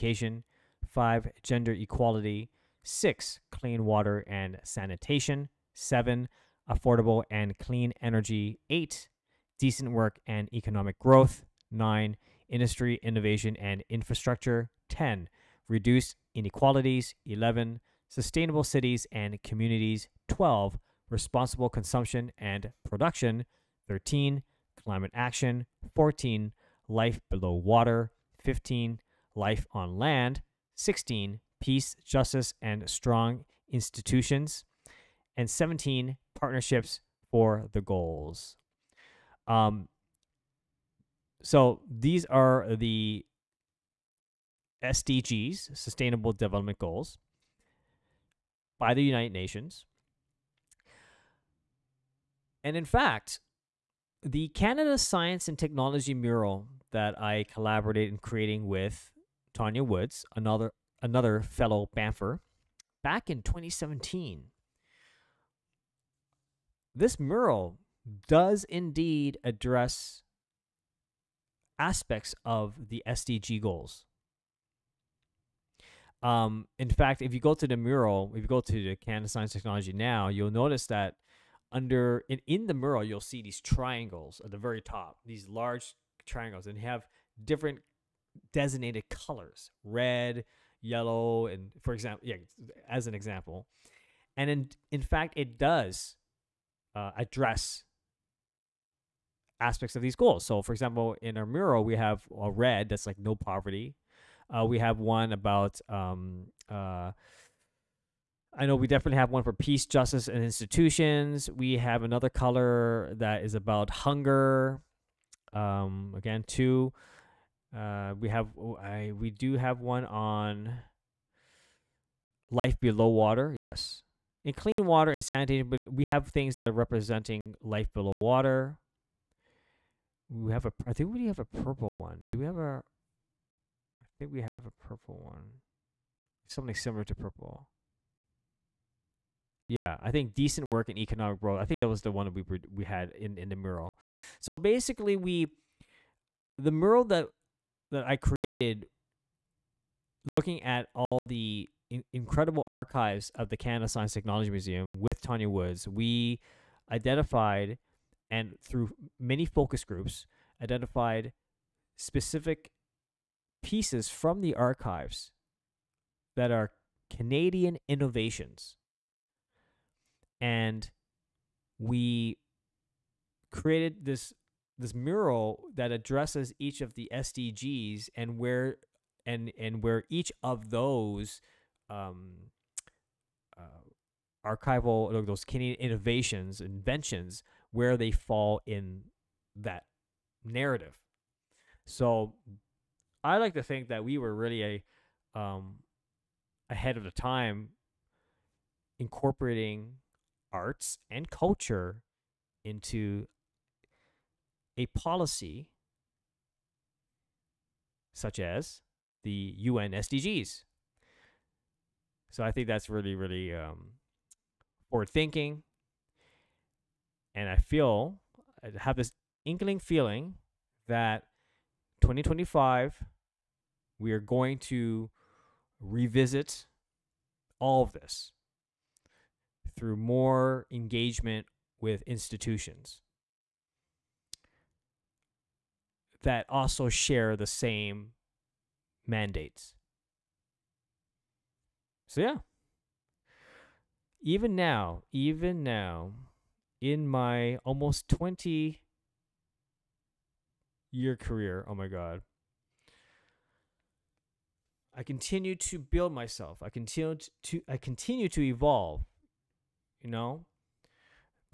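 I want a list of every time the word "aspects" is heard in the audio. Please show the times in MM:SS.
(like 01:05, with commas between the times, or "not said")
01:11, 01:39.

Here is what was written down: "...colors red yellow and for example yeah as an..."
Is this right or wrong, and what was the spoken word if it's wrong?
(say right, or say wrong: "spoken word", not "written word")
right.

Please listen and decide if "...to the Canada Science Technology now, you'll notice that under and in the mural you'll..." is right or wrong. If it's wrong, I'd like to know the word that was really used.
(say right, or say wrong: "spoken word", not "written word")
right.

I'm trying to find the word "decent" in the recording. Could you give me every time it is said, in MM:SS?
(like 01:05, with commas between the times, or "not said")
00:09, 02:20.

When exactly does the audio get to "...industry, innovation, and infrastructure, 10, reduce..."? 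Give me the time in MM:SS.
00:12.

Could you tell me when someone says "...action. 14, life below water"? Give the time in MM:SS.
00:25.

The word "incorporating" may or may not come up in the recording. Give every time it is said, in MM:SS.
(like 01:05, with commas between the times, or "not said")
03:18.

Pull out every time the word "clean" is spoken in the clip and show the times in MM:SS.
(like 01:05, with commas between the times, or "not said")
00:03, 00:07, 02:04.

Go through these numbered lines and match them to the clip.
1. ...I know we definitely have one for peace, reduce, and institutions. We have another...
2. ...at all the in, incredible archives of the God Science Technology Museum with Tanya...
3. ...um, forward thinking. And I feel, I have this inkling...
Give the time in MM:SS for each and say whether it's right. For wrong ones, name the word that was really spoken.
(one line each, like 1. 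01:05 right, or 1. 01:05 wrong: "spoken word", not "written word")
1. 01:48 wrong: "justice", not "reduce"
2. 02:30 wrong: "Canada", not "God"
3. 03:33 right.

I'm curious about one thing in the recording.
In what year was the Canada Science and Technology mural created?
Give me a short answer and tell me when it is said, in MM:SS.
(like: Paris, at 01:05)
2017, at 01:03.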